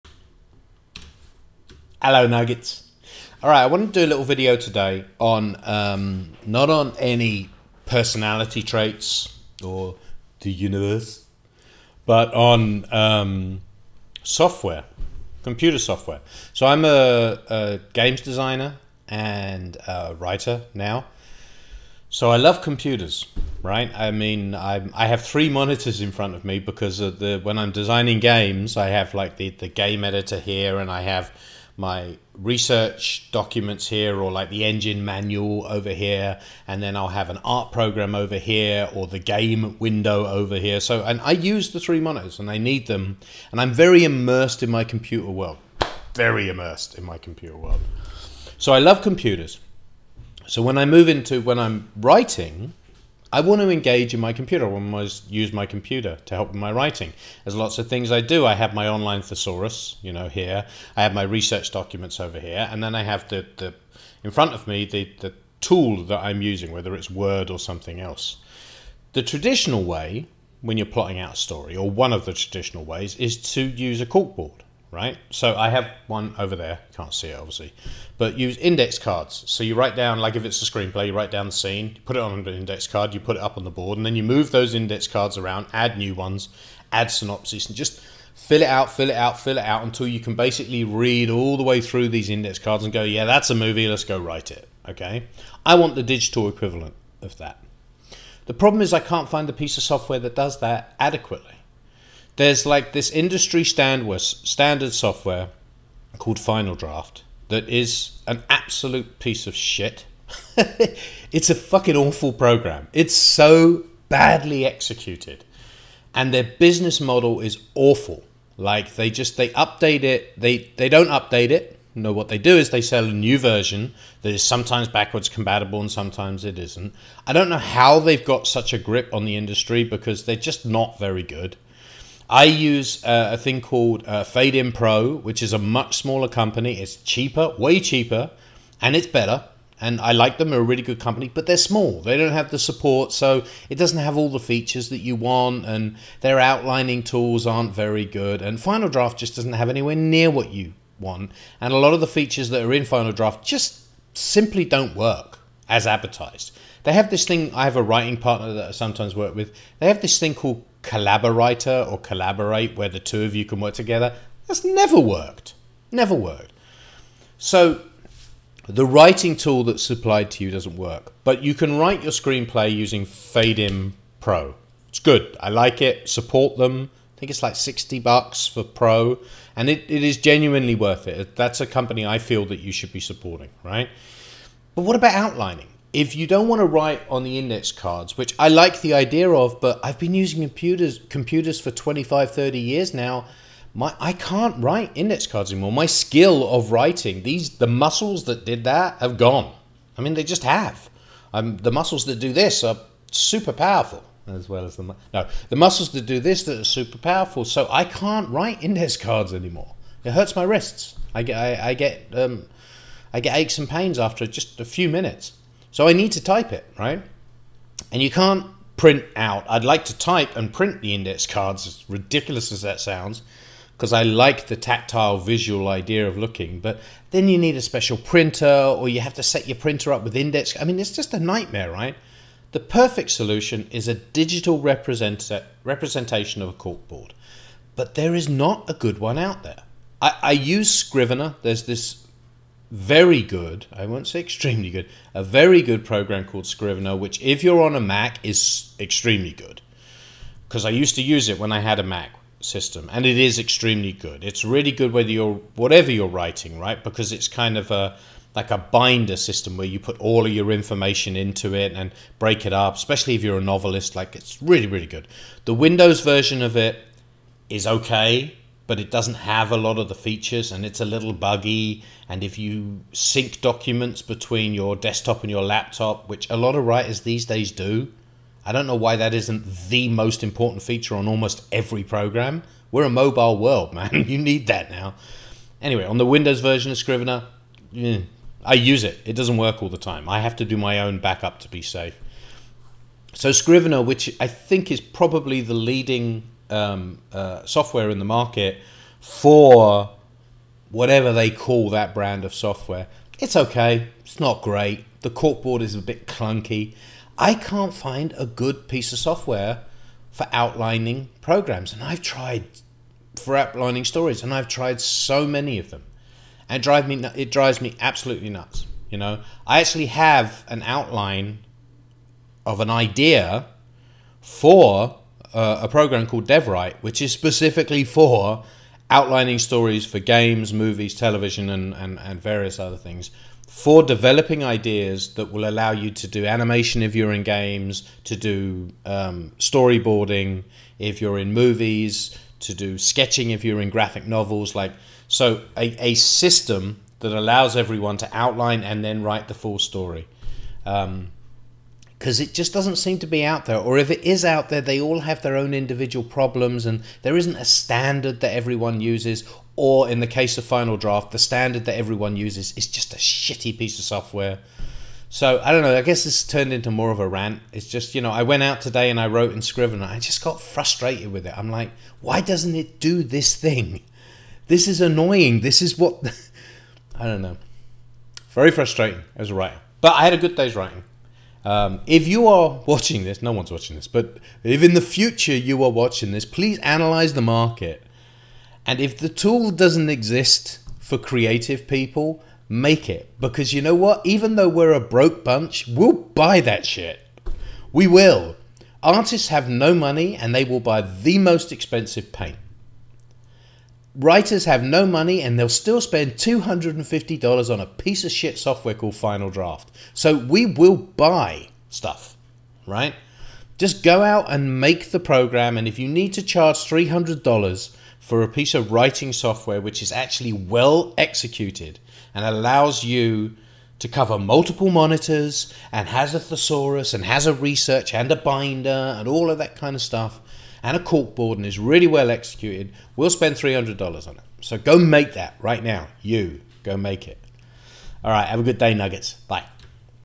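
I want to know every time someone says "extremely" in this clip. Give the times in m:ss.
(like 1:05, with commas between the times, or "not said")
4:04, 4:08, 4:13.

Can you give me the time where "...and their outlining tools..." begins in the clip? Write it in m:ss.
2:25.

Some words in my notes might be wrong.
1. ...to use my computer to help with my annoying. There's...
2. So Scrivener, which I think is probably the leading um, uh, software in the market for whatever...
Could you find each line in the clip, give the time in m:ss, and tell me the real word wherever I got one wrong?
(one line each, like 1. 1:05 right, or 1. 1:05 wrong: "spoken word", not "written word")
1. 0:55 wrong: "writing", not "annoying"
2. 4:53 right.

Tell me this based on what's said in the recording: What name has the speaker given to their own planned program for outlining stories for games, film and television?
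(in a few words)
DevWrite.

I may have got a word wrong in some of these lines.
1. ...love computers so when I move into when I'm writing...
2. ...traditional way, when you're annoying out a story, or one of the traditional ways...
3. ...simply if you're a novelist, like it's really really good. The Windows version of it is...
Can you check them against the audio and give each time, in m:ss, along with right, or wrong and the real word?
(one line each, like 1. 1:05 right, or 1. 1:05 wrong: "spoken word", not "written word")
1. 0:48 right
2. 1:09 wrong: "plotting", not "annoying"
3. 4:22 wrong: "especially", not "simply".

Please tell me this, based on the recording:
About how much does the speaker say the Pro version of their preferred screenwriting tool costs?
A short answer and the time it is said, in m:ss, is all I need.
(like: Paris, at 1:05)
$60, at 2:57.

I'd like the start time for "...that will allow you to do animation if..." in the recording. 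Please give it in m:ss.
5:35.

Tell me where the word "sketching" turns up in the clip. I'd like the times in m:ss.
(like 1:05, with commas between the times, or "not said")
5:42.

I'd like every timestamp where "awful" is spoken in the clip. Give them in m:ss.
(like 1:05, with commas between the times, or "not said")
1:51, 1:57.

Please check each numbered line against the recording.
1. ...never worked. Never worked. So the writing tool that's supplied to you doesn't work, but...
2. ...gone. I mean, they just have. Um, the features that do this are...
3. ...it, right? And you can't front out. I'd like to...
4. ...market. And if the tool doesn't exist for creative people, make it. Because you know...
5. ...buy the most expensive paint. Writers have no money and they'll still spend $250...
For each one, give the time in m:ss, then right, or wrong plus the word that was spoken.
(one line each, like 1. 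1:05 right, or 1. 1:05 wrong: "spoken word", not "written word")
1. 2:44 right
2. 3:19 wrong: "muscles", not "features"
3. 3:36 wrong: "print", not "front"
4. 6:27 right
5. 6:40 right.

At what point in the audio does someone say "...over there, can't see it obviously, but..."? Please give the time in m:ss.
1:16.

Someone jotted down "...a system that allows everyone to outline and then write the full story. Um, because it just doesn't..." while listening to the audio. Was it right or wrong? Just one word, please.
right.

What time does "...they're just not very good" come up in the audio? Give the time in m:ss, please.
2:10.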